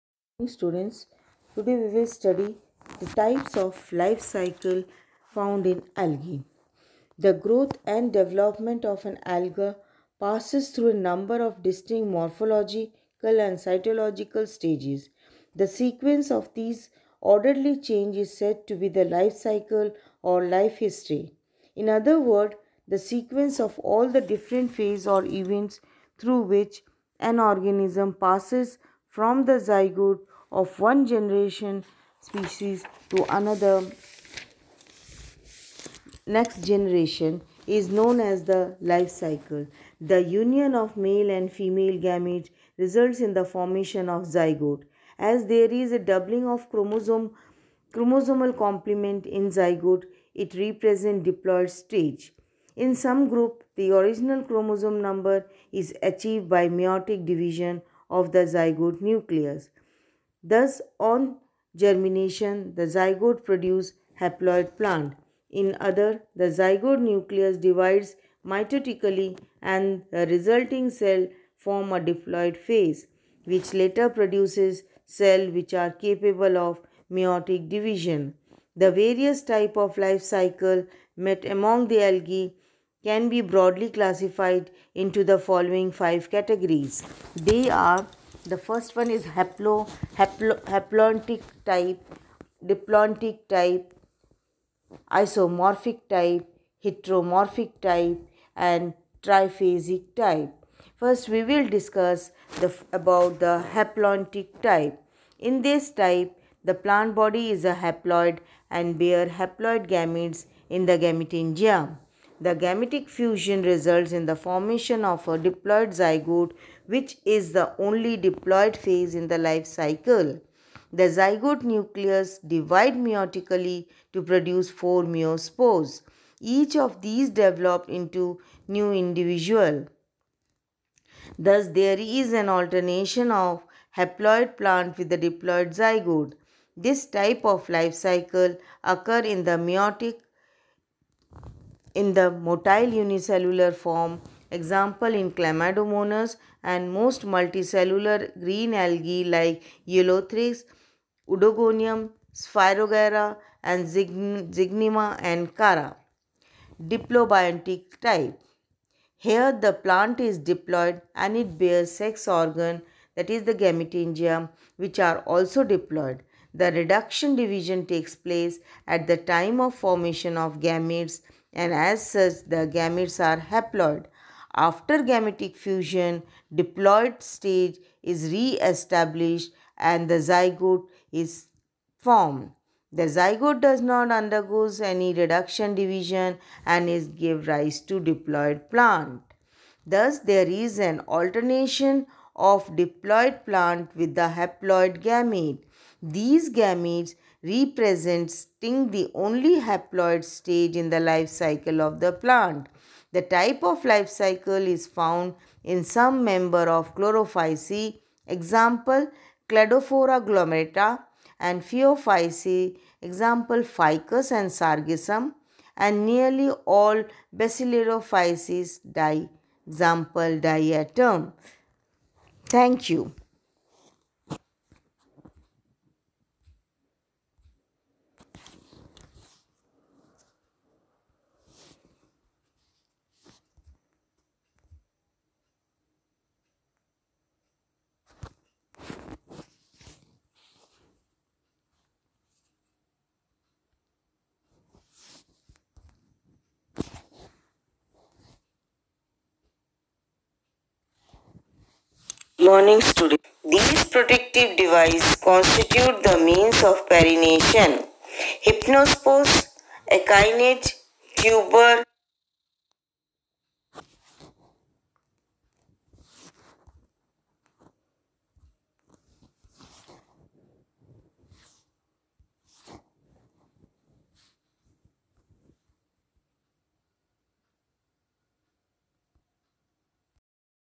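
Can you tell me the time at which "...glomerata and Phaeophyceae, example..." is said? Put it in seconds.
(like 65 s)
210 s.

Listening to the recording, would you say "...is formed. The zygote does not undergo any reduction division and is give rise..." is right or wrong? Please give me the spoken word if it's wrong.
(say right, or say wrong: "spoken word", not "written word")
right.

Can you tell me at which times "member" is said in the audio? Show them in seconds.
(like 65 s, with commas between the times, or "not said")
206 s.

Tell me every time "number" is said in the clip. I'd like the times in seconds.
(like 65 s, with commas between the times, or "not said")
11 s, 55 s.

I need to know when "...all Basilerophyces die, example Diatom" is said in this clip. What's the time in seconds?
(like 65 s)
216 s.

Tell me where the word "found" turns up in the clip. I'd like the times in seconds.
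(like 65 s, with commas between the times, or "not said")
5 s, 204 s.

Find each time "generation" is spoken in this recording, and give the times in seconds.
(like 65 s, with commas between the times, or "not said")
31 s, 36 s.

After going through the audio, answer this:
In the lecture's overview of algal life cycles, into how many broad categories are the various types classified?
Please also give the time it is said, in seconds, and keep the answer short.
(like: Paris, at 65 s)
5, at 85 s.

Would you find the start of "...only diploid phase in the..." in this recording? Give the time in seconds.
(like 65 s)
117 s.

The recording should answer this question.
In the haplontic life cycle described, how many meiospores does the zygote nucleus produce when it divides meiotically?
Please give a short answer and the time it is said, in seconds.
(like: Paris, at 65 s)
4, at 124 s.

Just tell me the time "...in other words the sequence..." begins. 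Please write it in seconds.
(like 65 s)
21 s.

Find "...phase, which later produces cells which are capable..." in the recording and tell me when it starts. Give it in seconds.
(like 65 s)
72 s.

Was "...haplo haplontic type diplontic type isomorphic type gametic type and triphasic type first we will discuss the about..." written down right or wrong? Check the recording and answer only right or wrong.
wrong.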